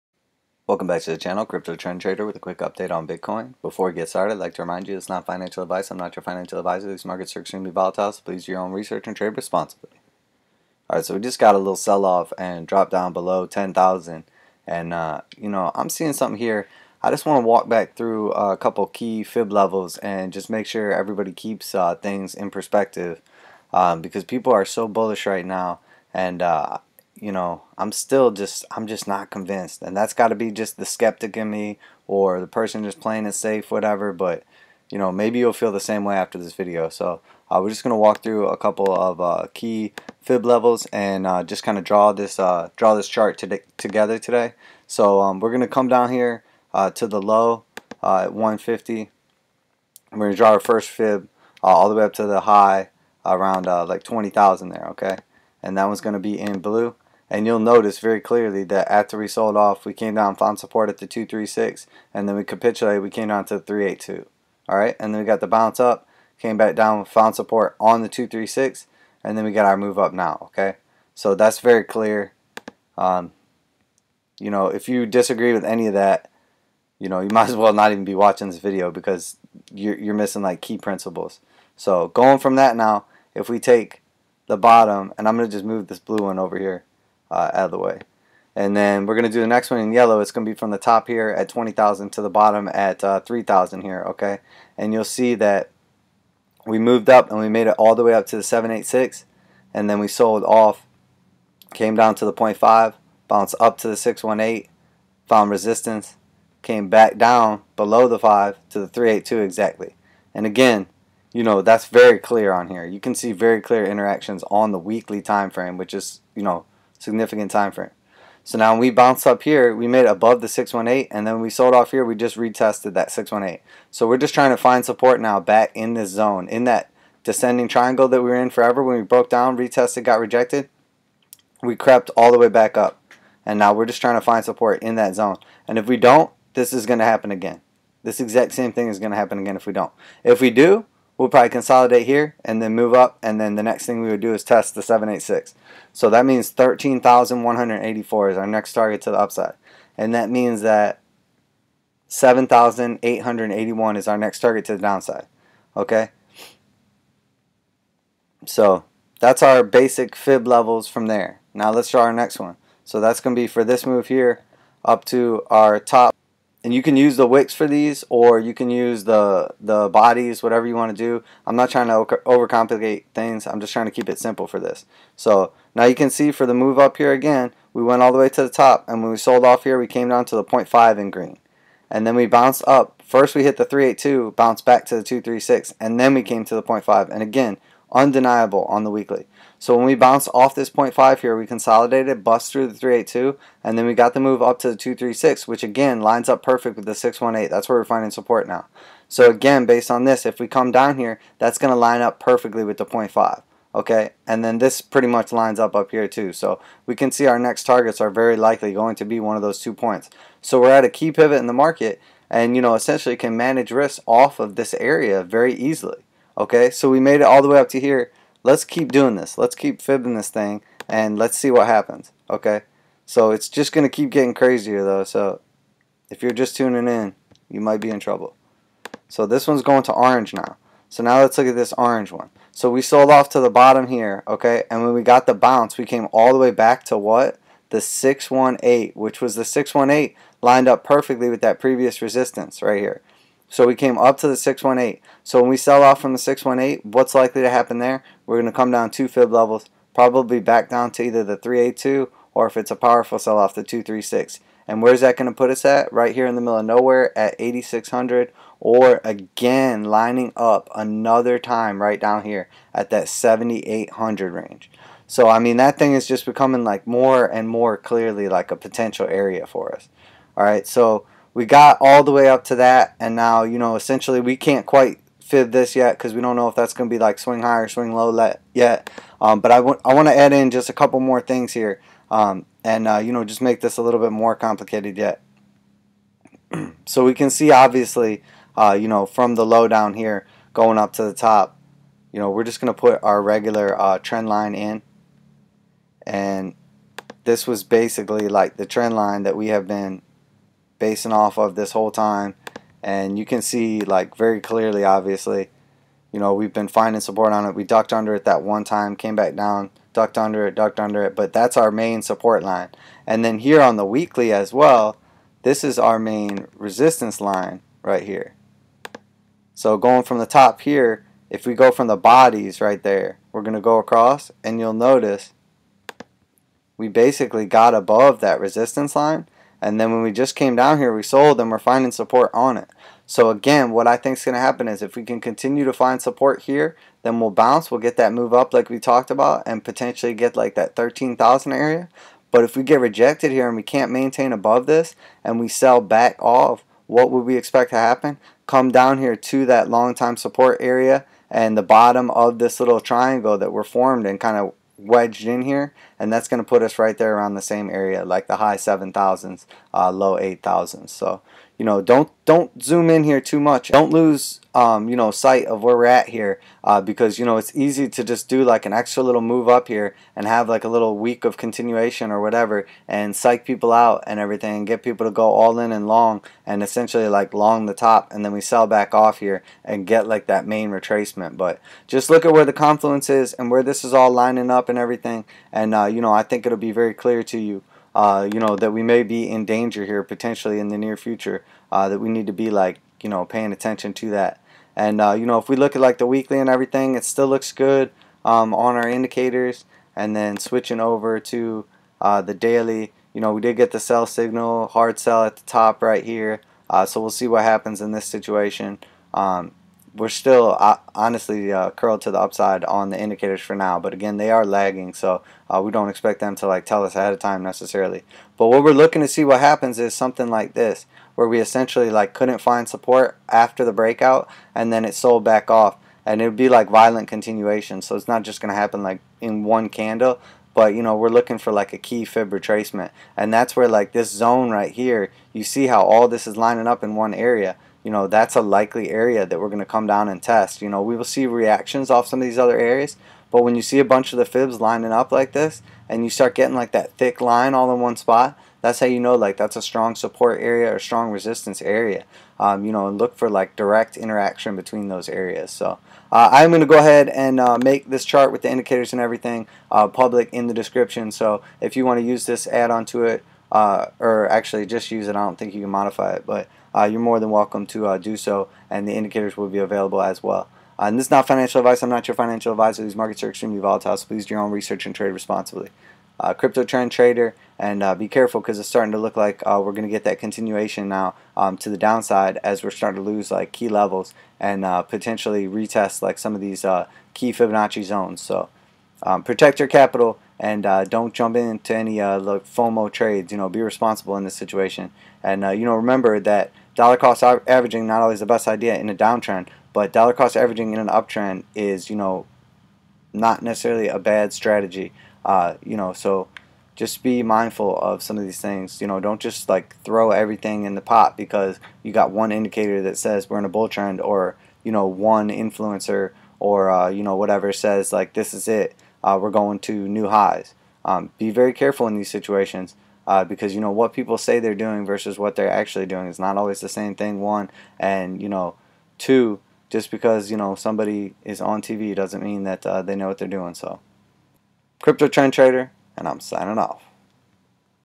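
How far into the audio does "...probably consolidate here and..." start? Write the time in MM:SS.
02:21.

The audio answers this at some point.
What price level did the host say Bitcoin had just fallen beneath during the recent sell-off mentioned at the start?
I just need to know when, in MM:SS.
00:13.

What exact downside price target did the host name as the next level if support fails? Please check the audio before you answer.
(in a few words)
7,881.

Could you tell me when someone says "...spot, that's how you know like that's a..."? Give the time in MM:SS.
07:27.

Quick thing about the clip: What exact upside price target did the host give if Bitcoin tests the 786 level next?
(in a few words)
13,184.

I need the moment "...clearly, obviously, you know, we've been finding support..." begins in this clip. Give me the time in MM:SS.
05:04.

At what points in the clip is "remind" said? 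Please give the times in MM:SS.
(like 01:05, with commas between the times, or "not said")
00:04.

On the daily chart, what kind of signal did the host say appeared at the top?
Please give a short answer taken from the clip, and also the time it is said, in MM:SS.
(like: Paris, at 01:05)
hard sell, at 06:44.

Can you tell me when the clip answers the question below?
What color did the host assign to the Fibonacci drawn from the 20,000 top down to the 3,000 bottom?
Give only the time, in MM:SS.
01:29.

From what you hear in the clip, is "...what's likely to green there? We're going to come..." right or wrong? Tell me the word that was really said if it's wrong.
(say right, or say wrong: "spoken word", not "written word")
wrong: "happen", not "green".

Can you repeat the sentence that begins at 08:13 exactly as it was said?
You know, be responsible in this situation.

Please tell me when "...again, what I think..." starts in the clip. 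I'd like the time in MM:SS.
05:33.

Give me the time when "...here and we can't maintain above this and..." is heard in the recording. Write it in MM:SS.
05:43.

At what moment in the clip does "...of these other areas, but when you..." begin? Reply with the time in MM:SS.
07:22.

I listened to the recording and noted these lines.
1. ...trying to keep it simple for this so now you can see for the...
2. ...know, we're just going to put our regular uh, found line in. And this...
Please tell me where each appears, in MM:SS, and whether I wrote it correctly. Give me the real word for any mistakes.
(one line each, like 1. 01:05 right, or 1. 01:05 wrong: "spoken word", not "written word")
1. 02:53 right
2. 04:52 wrong: "trend", not "found".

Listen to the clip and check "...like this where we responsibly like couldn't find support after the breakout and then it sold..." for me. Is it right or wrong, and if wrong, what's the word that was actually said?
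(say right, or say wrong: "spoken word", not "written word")
wrong: "essentially", not "responsibly".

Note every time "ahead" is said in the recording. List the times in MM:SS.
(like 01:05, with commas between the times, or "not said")
06:56, 07:36.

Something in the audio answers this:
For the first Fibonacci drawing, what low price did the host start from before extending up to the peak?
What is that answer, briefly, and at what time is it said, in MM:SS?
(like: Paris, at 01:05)
150, at 00:48.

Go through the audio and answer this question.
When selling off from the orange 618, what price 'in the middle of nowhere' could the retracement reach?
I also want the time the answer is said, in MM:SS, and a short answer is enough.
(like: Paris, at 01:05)
8600, at 04:17.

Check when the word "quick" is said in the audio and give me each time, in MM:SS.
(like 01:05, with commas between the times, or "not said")
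00:02.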